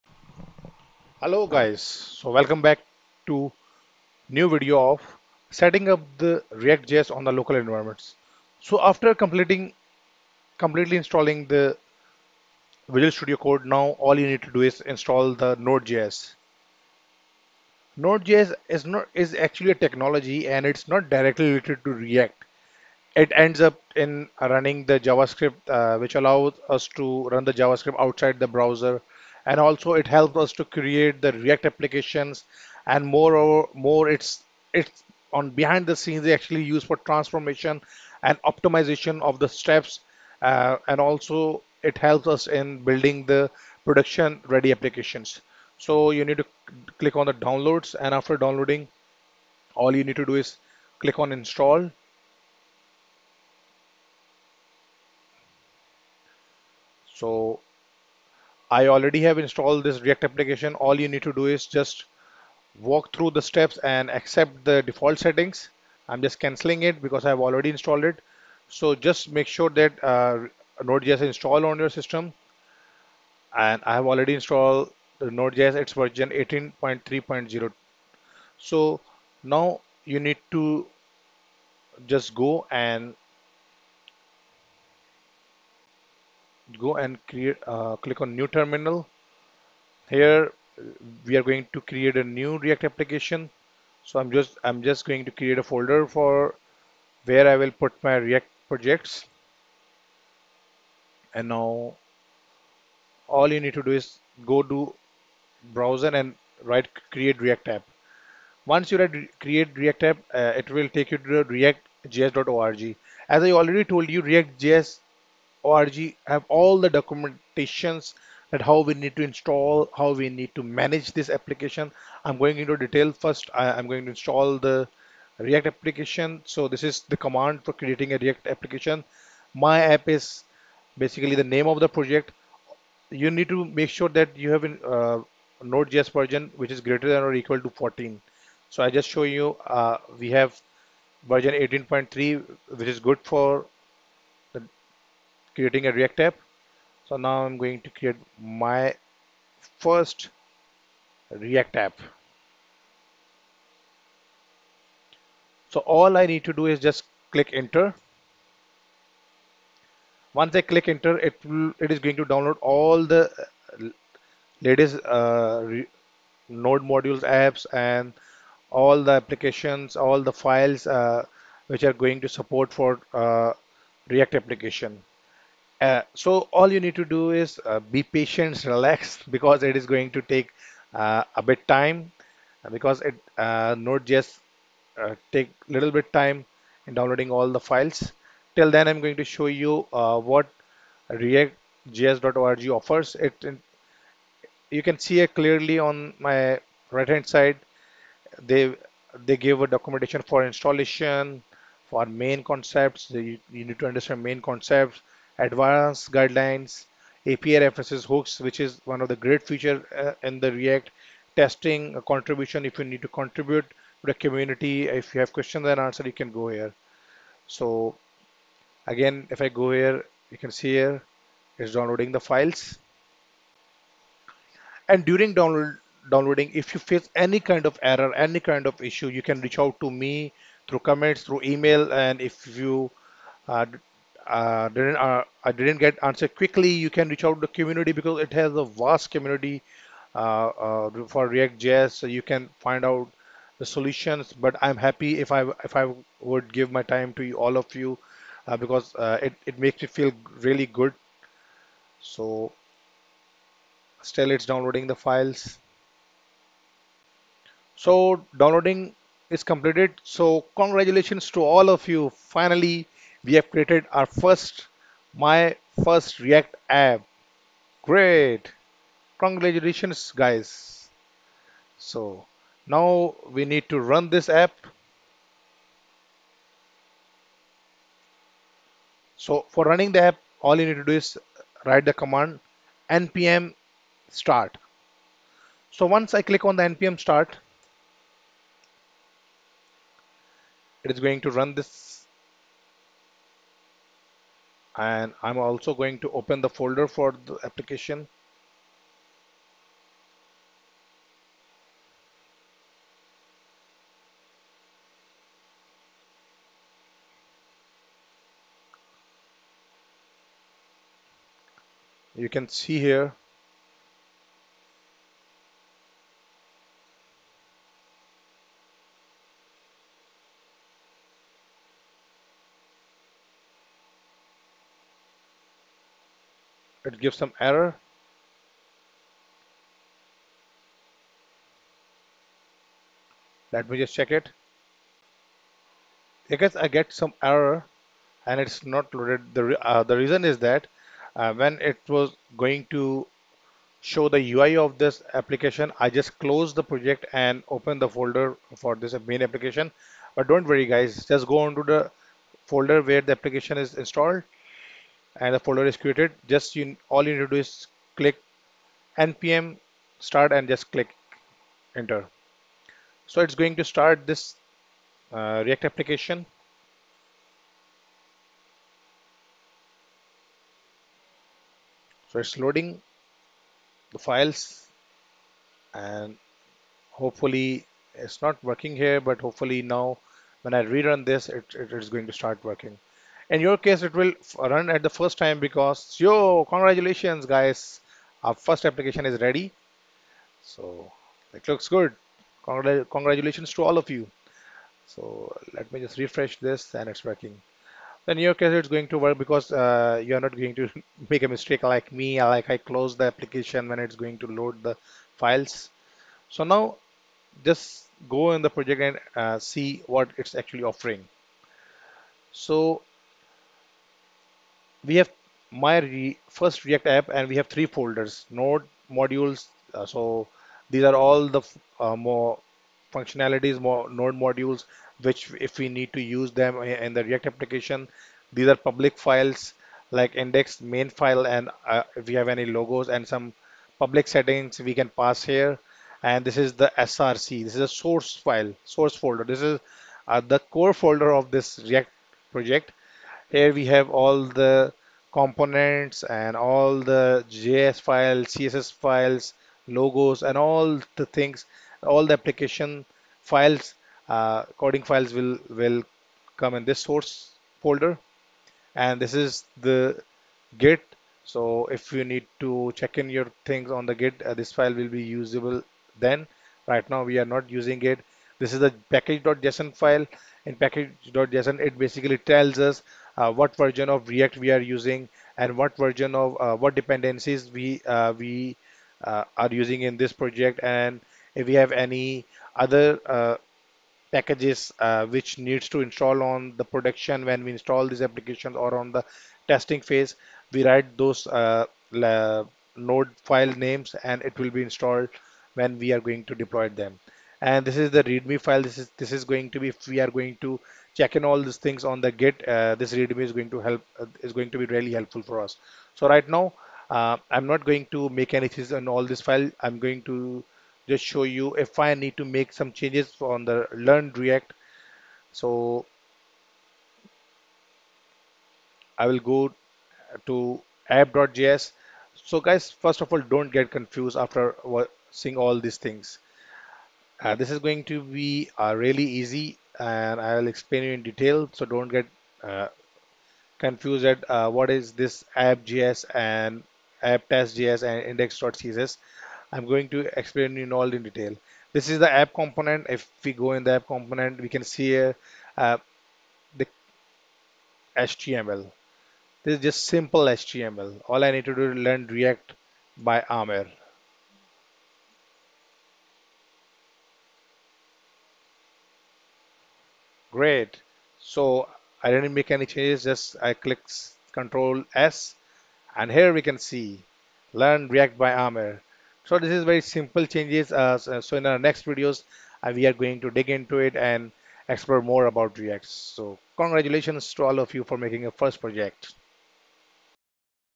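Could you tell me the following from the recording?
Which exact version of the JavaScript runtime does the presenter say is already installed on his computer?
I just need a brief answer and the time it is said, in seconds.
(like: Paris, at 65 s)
18.3.0, at 76 s.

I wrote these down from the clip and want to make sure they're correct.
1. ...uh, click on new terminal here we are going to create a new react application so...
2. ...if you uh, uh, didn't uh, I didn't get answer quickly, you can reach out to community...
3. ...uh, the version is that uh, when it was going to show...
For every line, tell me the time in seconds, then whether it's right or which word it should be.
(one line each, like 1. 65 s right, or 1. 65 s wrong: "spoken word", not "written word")
1. 87 s right
2. 232 s right
3. 339 s wrong: "reason", not "version".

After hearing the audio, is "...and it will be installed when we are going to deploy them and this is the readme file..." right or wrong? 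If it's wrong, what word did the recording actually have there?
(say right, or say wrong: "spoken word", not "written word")
right.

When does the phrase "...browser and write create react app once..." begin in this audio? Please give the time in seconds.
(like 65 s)
105 s.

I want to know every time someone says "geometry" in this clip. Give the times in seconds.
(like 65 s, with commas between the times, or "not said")
not said.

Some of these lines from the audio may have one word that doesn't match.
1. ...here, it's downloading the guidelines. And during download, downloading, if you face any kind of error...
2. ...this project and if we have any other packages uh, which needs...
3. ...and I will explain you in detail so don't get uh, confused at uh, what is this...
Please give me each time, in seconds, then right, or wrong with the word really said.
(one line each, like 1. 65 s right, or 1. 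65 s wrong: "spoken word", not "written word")
1. 220 s wrong: "files", not "guidelines"
2. 479 s right
3. 529 s right.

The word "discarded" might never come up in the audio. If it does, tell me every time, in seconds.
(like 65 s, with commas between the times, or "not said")
not said.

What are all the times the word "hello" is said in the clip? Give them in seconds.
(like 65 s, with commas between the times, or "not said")
1 s.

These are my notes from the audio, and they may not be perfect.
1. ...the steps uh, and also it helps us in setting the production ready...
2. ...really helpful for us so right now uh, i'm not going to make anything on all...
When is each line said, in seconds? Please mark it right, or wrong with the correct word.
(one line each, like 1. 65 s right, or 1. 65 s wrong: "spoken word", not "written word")
1. 39 s wrong: "building", not "setting"
2. 504 s right.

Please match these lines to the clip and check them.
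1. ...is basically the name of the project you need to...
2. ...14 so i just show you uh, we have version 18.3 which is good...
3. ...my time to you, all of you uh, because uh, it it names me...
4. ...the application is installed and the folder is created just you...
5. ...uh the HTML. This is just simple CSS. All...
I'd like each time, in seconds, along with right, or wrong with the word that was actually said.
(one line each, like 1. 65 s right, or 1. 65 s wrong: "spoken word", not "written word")
1. 130 s right
2. 137 s right
3. 246 s wrong: "makes", not "names"
4. 353 s right
5. 545 s wrong: "HTML", not "CSS".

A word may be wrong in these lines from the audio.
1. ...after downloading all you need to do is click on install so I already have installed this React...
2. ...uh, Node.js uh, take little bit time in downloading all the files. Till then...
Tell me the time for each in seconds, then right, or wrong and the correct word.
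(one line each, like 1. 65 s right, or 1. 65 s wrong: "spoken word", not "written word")
1. 48 s right
2. 183 s right.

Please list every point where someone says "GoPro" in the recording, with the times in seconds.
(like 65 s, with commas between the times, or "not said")
not said.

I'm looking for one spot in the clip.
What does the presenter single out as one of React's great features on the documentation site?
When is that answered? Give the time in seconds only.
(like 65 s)
208 s.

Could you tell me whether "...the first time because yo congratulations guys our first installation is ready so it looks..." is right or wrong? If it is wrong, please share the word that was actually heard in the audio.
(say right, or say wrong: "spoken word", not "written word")
wrong: "application", not "installation".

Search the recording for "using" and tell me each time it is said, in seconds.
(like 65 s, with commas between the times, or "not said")
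467 s, 474 s, 479 s.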